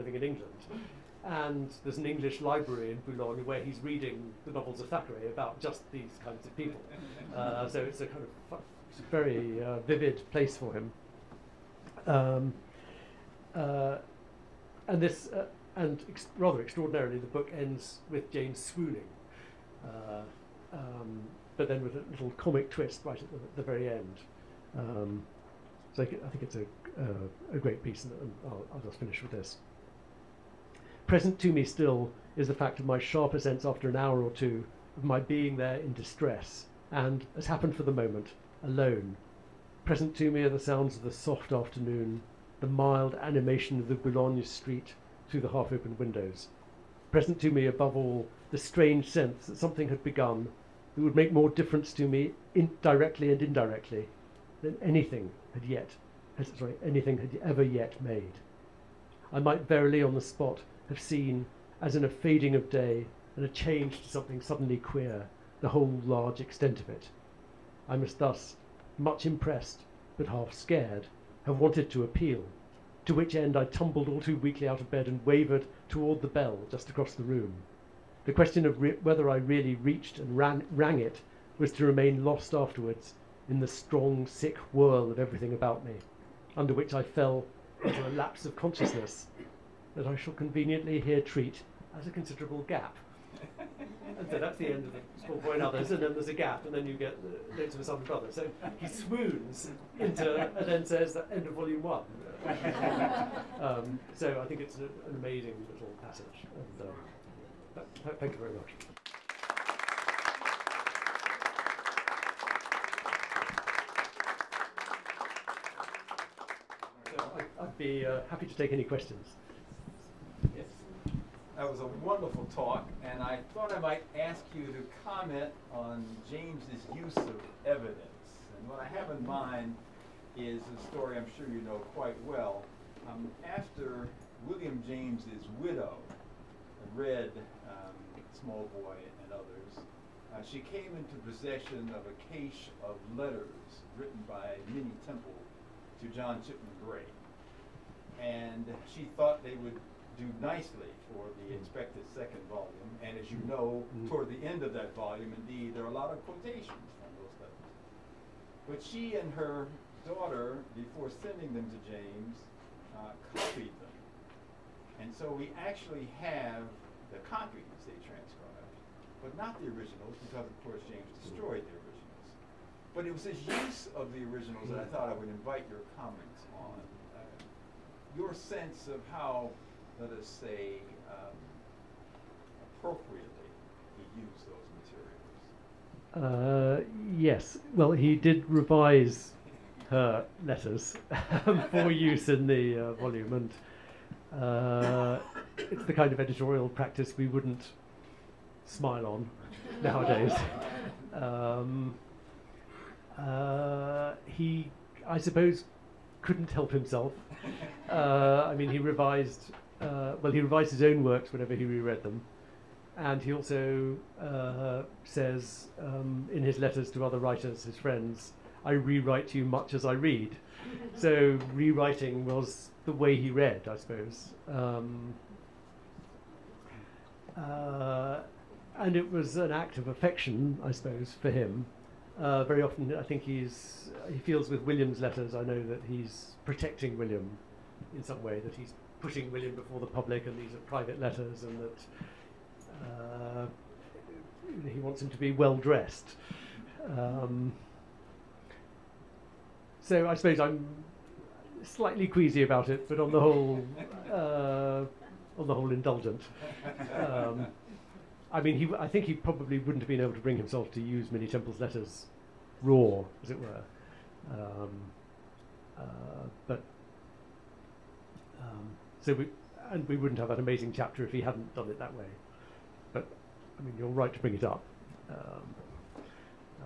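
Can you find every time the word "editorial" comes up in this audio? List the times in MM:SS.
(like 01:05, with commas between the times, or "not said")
03:16.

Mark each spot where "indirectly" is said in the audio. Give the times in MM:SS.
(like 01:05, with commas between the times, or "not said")
00:53.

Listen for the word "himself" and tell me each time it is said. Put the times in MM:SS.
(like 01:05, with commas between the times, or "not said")
03:26, 04:20.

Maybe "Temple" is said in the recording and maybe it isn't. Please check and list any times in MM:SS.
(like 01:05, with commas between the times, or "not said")
02:25, 04:21.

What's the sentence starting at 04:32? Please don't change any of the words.
But I mean, you're right to bring it up.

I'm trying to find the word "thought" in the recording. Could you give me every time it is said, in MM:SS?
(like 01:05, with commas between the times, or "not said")
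02:03, 02:29, 02:54.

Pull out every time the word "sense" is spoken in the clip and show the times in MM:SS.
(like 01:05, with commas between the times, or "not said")
00:33, 00:49, 02:58.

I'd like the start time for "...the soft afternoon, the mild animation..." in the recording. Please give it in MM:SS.
00:41.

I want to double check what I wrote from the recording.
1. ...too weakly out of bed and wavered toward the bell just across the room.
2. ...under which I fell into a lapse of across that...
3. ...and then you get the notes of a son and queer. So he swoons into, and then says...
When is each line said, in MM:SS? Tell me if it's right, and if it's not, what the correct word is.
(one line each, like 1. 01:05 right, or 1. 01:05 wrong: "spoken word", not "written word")
1. 01:14 right
2. 01:26 wrong: "consciousness", not "across"
3. 01:36 wrong: "brother", not "queer".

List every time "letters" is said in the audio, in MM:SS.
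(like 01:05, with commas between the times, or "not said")
02:23, 02:37, 03:10, 03:36, 03:54, 04:01, 04:21.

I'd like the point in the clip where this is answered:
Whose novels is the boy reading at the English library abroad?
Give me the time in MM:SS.
00:04.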